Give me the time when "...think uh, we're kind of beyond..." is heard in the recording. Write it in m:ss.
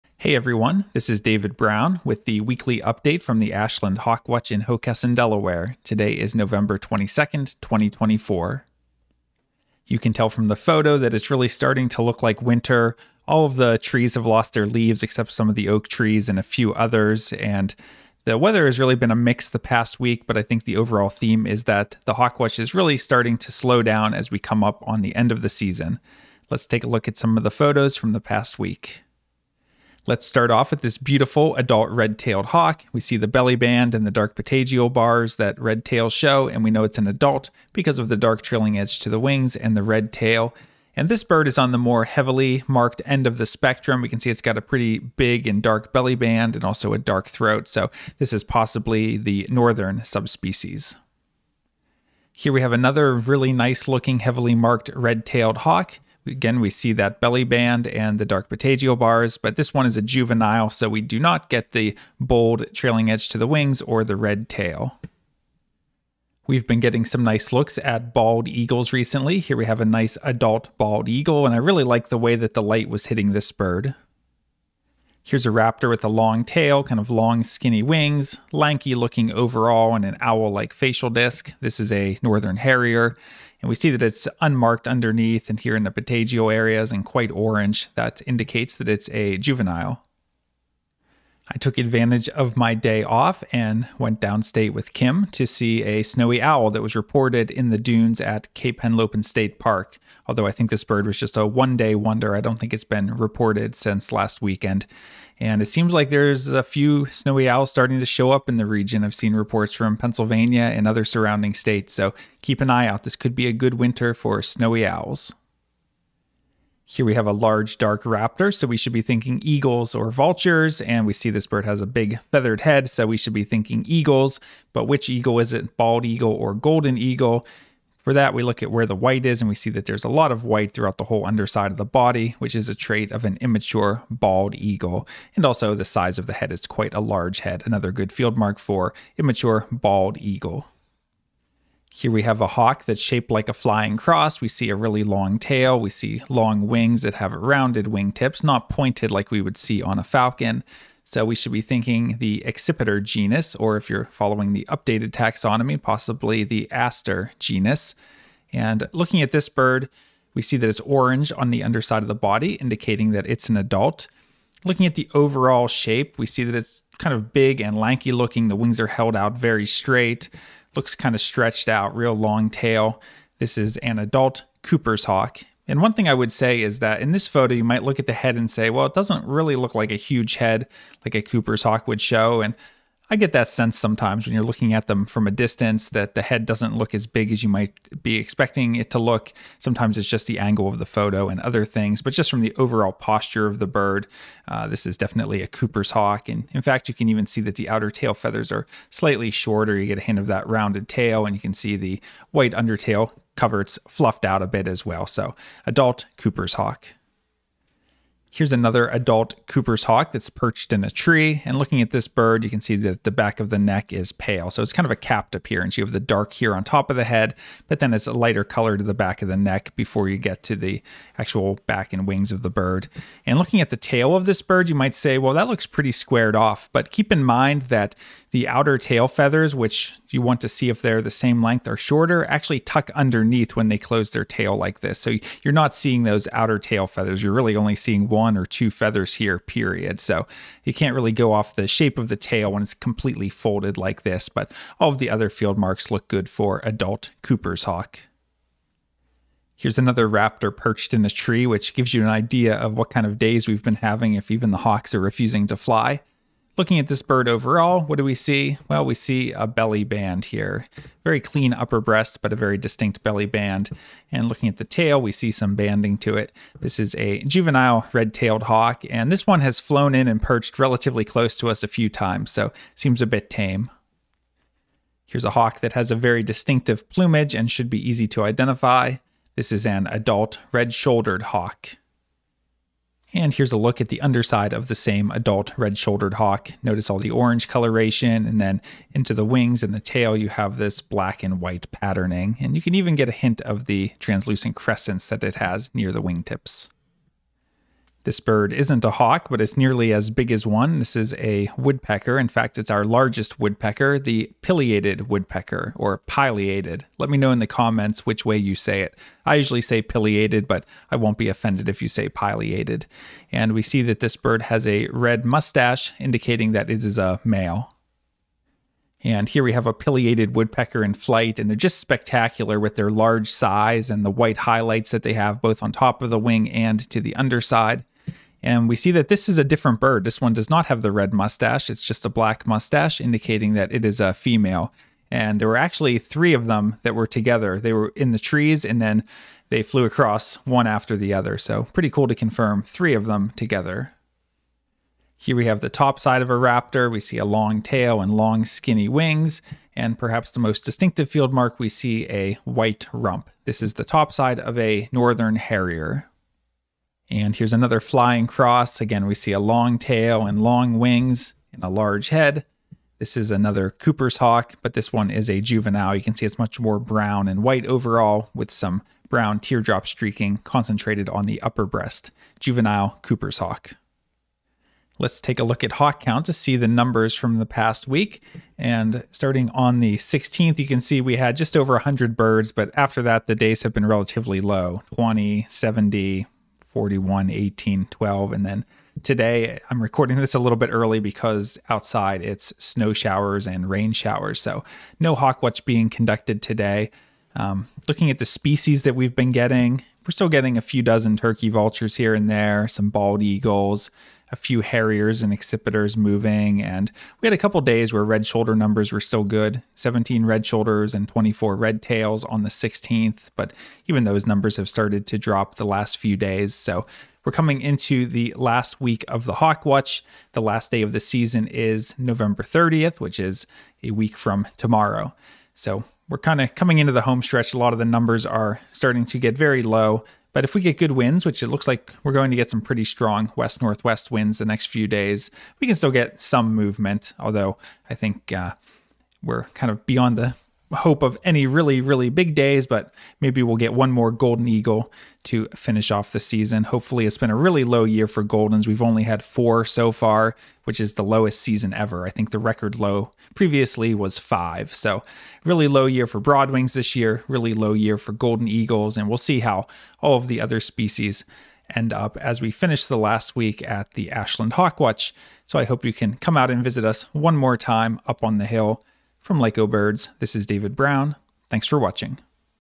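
7:17.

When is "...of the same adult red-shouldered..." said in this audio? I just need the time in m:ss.
4:44.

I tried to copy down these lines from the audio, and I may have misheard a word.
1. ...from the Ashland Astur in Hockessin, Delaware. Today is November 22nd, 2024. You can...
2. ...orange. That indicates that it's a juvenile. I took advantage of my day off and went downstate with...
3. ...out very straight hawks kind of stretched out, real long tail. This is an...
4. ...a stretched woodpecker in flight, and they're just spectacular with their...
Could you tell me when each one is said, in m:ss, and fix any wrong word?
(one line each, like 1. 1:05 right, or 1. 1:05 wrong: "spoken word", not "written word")
1. 0:03 wrong: "Hawkwatch", not "Astur"
2. 1:27 right
3. 2:49 wrong: "looks", not "hawks"
4. 5:19 wrong: "pileated", not "stretched".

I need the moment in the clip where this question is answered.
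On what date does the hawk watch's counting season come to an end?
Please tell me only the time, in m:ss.
7:01.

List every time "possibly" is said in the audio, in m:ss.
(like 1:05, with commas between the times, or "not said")
0:48, 2:35.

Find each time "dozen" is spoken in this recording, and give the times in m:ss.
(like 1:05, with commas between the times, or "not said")
6:40.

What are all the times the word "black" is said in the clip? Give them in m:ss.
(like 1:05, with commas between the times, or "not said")
4:50, 5:32.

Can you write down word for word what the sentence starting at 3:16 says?
And in fact, you can even see that the outer tail feathers are slightly shorter.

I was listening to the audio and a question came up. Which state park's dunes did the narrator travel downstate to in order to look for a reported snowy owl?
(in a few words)
Cape Henlopen State Park.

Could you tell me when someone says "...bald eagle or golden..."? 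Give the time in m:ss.
2:05.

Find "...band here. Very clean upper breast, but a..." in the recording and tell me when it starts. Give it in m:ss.
4:19.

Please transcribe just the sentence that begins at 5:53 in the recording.
This is the top side of a northern harrier.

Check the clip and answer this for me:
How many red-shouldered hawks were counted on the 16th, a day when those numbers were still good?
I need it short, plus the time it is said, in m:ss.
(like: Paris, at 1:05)
17, at 6:49.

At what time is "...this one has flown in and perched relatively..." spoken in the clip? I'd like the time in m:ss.
4:29.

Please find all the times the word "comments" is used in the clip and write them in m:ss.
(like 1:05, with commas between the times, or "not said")
5:07.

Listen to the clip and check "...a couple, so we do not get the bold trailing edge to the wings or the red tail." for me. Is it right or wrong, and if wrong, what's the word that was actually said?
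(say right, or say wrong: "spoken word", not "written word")
wrong: "juvenile", not "couple".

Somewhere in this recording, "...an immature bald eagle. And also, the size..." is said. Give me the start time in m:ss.
2:13.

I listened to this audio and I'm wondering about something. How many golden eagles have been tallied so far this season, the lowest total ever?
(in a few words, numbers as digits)
4.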